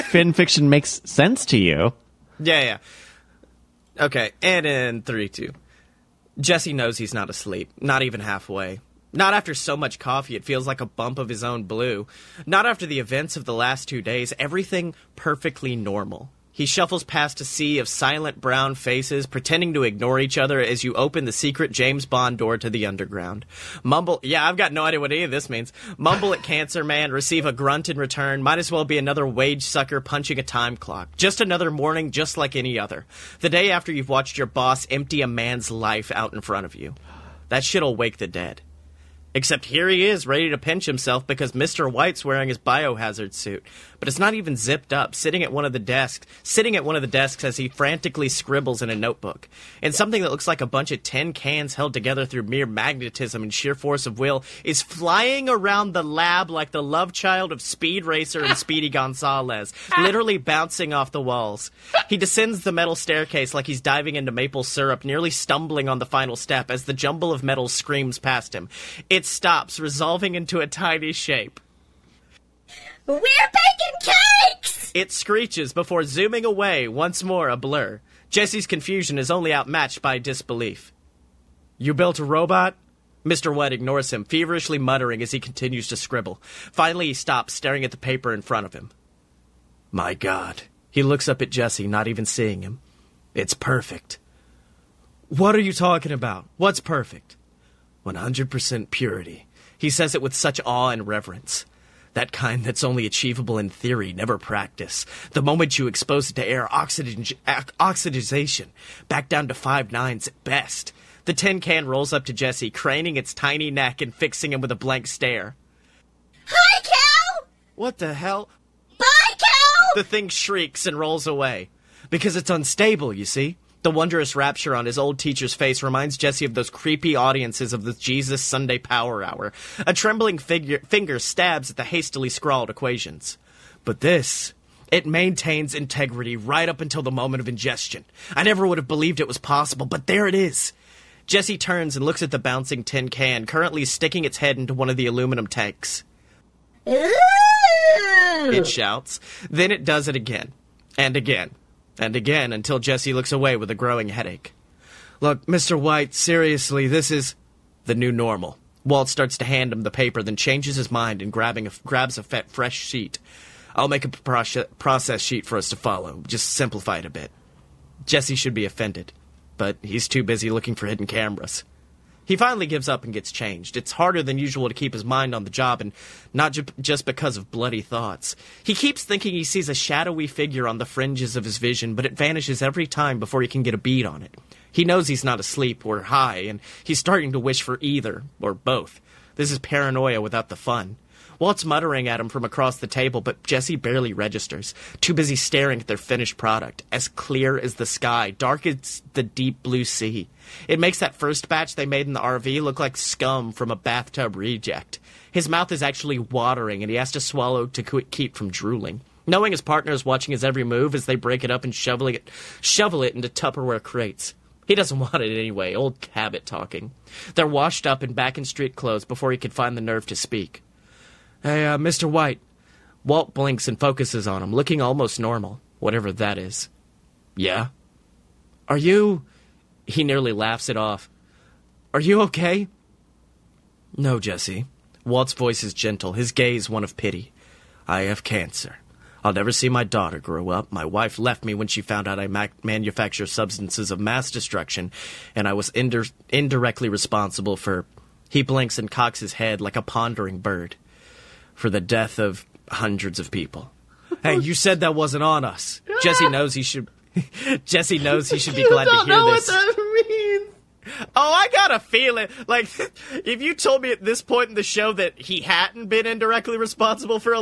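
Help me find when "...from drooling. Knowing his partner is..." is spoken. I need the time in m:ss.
3:28.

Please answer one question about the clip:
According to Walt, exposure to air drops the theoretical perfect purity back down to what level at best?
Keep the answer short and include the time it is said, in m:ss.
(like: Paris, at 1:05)
Five nines, at 1:49.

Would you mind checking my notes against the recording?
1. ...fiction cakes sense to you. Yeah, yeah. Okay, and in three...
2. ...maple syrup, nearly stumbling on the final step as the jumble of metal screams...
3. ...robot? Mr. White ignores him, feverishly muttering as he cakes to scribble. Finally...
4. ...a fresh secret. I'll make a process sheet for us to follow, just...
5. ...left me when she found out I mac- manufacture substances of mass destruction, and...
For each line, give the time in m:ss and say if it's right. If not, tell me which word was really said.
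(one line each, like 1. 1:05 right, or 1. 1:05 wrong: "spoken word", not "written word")
1. 0:00 wrong: "makes", not "cakes"
2. 1:04 right
3. 1:22 wrong: "continues", not "cakes"
4. 2:42 wrong: "sheet", not "secret"
5. 4:01 right.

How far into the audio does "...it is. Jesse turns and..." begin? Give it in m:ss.
2:20.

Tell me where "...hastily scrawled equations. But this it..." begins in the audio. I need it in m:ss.
2:11.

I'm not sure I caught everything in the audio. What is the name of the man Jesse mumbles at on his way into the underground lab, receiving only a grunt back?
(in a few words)
Cancer Man.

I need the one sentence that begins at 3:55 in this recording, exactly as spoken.
Walt's voice is gentle, his gaze one of pity.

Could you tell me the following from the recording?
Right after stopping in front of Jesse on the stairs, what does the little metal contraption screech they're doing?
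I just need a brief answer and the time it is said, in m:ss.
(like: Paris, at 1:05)
Baking cakes, at 1:13.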